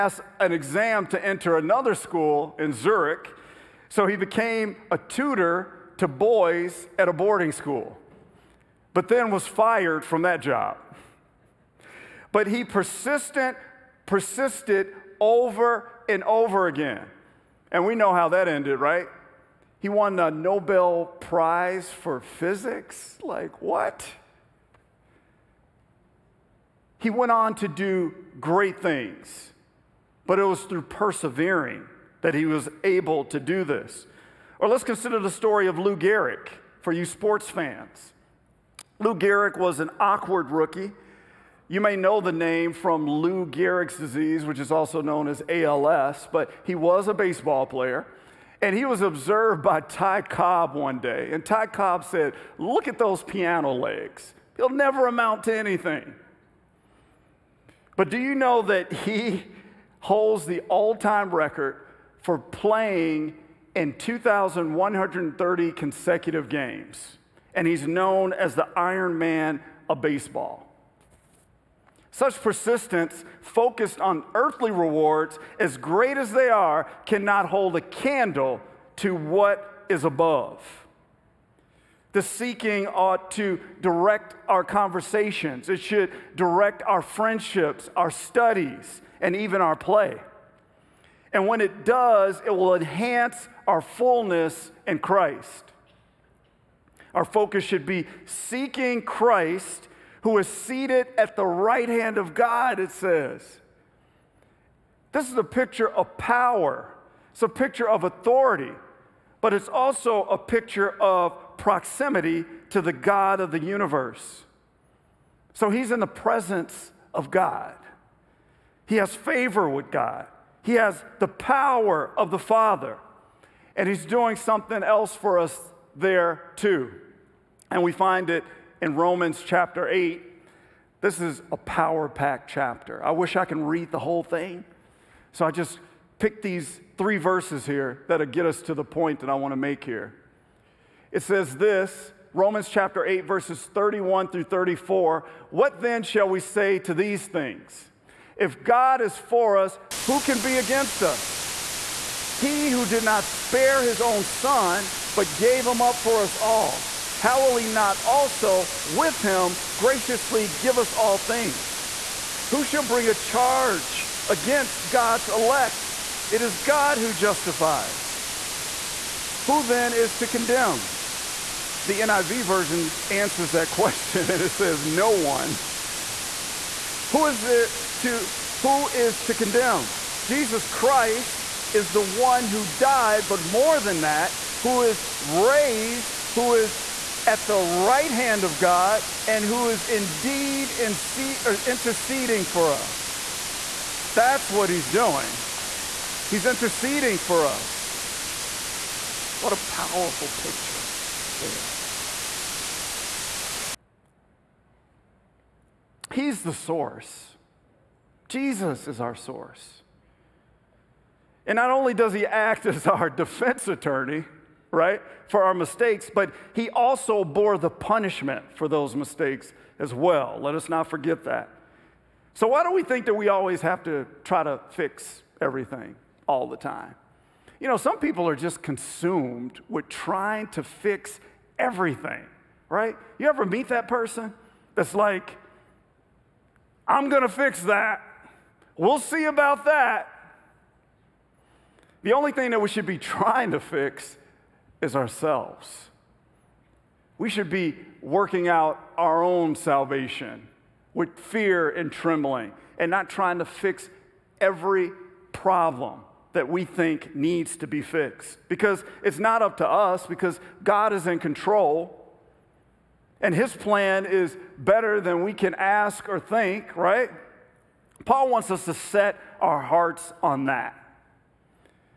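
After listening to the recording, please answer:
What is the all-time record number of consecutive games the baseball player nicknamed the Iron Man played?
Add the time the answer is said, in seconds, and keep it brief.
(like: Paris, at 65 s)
2,130, at 63 s.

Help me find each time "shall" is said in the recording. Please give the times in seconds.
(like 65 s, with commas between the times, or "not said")
146 s, 162 s.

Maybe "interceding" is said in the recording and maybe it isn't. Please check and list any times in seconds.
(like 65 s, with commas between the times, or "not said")
191 s, 196 s.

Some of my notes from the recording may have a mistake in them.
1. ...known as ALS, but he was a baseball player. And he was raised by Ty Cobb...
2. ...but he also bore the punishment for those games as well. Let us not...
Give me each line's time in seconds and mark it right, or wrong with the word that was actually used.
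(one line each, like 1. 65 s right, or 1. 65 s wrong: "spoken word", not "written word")
1. 44 s wrong: "observed", not "raised"
2. 216 s wrong: "mistakes", not "games".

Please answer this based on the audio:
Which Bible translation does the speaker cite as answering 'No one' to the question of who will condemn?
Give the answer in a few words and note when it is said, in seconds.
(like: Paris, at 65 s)
NIV, at 171 s.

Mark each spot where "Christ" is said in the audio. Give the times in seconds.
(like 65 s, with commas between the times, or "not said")
94 s, 99 s, 180 s.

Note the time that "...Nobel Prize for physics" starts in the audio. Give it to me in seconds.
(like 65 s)
20 s.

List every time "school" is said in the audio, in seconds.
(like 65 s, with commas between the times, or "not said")
1 s, 7 s.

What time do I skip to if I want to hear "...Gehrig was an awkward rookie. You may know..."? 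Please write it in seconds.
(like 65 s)
39 s.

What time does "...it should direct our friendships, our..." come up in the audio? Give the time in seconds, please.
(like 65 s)
85 s.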